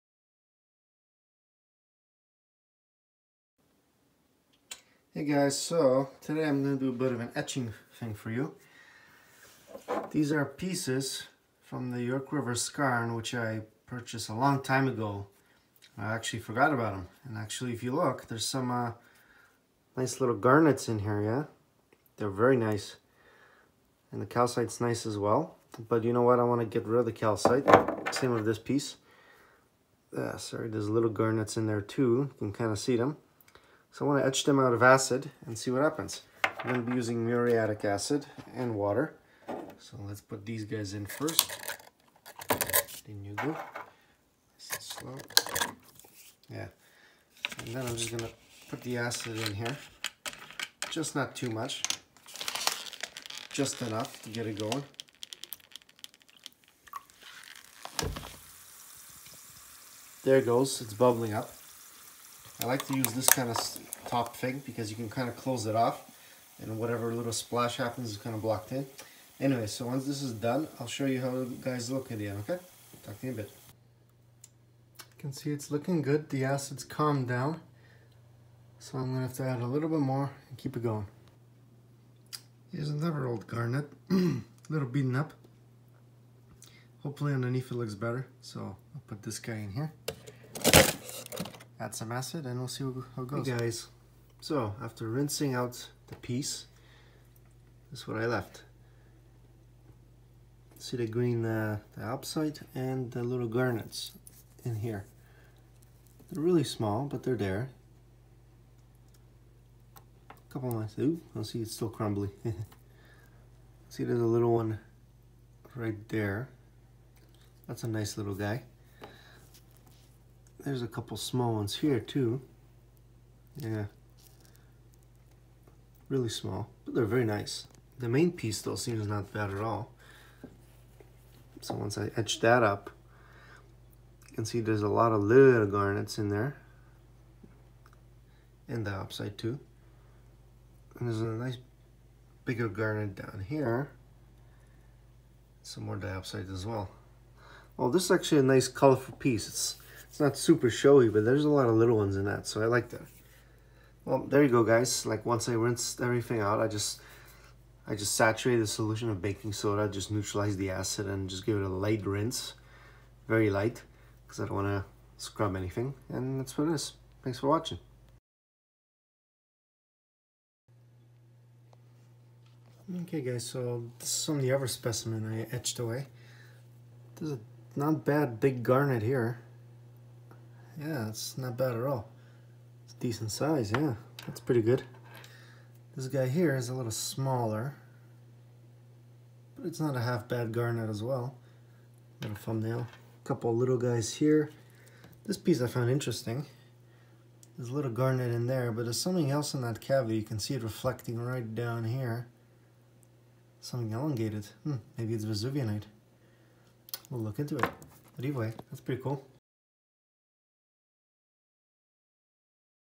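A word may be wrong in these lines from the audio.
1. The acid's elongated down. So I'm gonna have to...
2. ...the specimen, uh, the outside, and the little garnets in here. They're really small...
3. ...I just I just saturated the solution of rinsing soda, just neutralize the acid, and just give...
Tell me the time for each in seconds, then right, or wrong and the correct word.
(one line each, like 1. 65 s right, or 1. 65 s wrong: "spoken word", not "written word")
1. 76 s wrong: "calmed", not "elongated"
2. 100 s wrong: "green", not "specimen"
3. 156 s wrong: "baking", not "rinsing".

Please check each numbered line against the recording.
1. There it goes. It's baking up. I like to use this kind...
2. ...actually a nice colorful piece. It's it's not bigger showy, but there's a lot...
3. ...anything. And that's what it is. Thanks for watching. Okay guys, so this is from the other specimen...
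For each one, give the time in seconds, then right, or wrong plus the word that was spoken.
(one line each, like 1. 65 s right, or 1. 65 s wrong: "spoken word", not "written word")
1. 60 s wrong: "bubbling", not "baking"
2. 148 s wrong: "super", not "bigger"
3. 165 s right.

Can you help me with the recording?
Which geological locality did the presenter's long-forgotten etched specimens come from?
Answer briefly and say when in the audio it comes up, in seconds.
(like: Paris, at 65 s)
York River Skarn, at 12 s.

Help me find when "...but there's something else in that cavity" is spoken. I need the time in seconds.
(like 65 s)
198 s.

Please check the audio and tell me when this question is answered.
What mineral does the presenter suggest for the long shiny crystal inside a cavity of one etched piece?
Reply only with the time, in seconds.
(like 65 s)
205 s.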